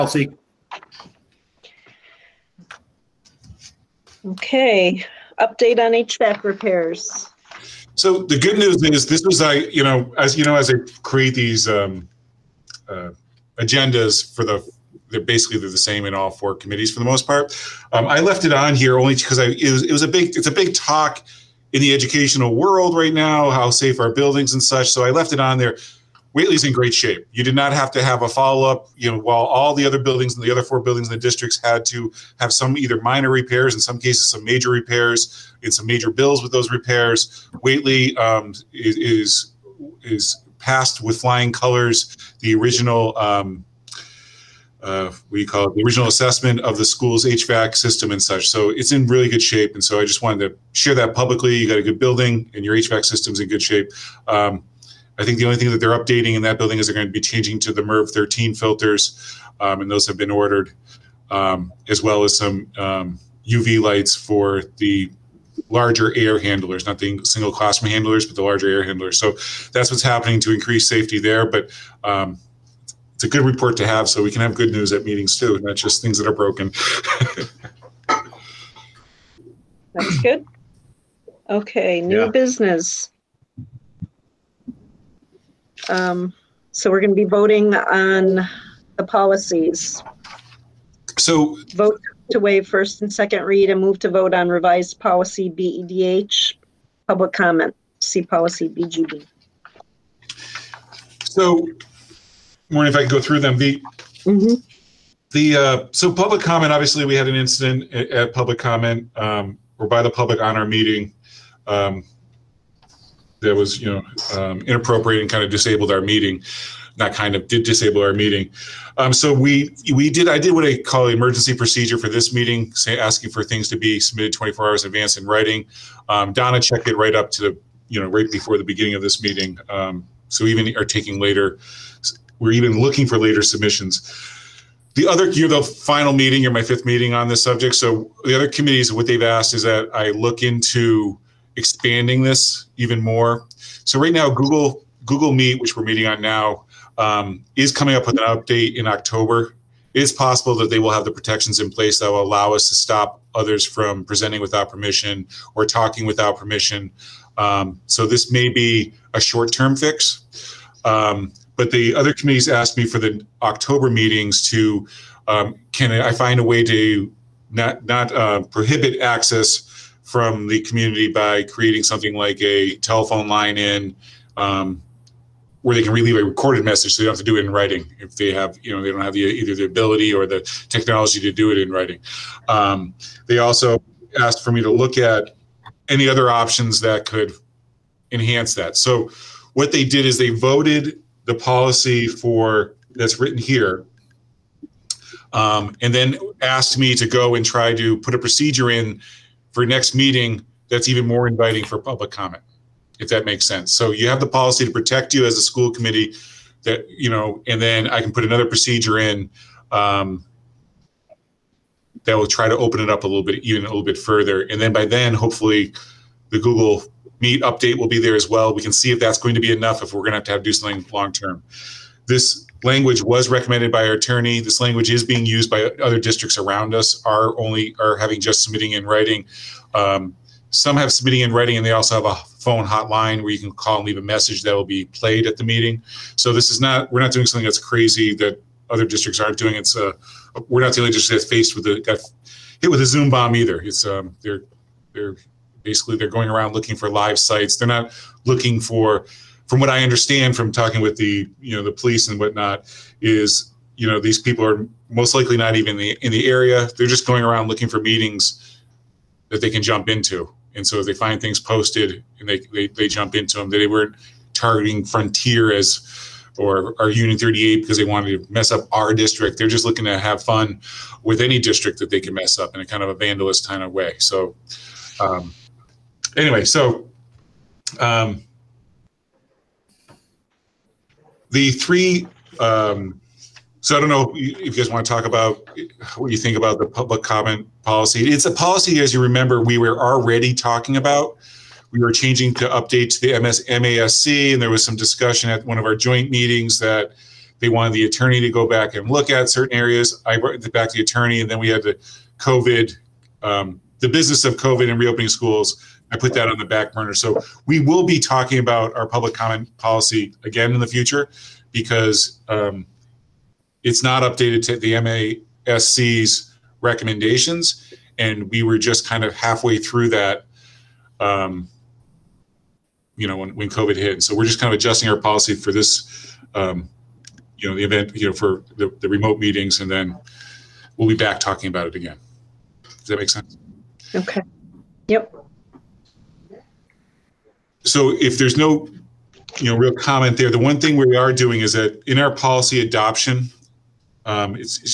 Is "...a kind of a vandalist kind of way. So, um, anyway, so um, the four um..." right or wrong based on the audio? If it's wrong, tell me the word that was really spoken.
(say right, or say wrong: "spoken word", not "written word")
wrong: "three", not "four".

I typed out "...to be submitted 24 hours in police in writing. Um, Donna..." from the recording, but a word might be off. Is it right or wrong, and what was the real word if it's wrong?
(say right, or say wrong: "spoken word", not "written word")
wrong: "advance", not "police".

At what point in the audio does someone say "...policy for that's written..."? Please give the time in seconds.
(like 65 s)
191 s.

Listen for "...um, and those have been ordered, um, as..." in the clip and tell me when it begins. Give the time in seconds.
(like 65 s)
59 s.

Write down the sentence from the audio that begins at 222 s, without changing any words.
This language was recommended by our attorney.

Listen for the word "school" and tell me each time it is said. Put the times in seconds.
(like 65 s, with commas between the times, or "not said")
46 s, 205 s, 305 s.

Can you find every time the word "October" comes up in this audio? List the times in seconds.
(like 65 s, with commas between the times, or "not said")
148 s, 163 s.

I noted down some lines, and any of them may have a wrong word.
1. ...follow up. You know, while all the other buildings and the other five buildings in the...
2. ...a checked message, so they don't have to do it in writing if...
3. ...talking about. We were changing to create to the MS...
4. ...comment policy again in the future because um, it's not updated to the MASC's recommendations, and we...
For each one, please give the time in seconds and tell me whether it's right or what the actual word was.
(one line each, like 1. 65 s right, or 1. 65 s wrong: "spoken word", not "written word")
1. 28 s wrong: "four", not "five"
2. 176 s wrong: "recorded", not "checked"
3. 290 s wrong: "update", not "create"
4. 309 s right.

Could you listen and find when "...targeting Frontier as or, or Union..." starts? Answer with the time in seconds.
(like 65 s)
264 s.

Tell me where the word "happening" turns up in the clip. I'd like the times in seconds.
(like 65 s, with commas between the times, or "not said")
70 s.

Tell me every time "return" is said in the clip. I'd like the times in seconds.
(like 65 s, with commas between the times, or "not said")
not said.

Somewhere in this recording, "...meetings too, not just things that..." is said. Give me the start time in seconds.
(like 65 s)
75 s.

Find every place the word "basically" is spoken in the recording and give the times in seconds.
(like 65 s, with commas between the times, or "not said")
15 s, 245 s.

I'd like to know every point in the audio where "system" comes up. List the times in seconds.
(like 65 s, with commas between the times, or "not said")
47 s, 53 s.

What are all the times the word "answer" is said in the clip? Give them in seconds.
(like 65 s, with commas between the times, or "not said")
not said.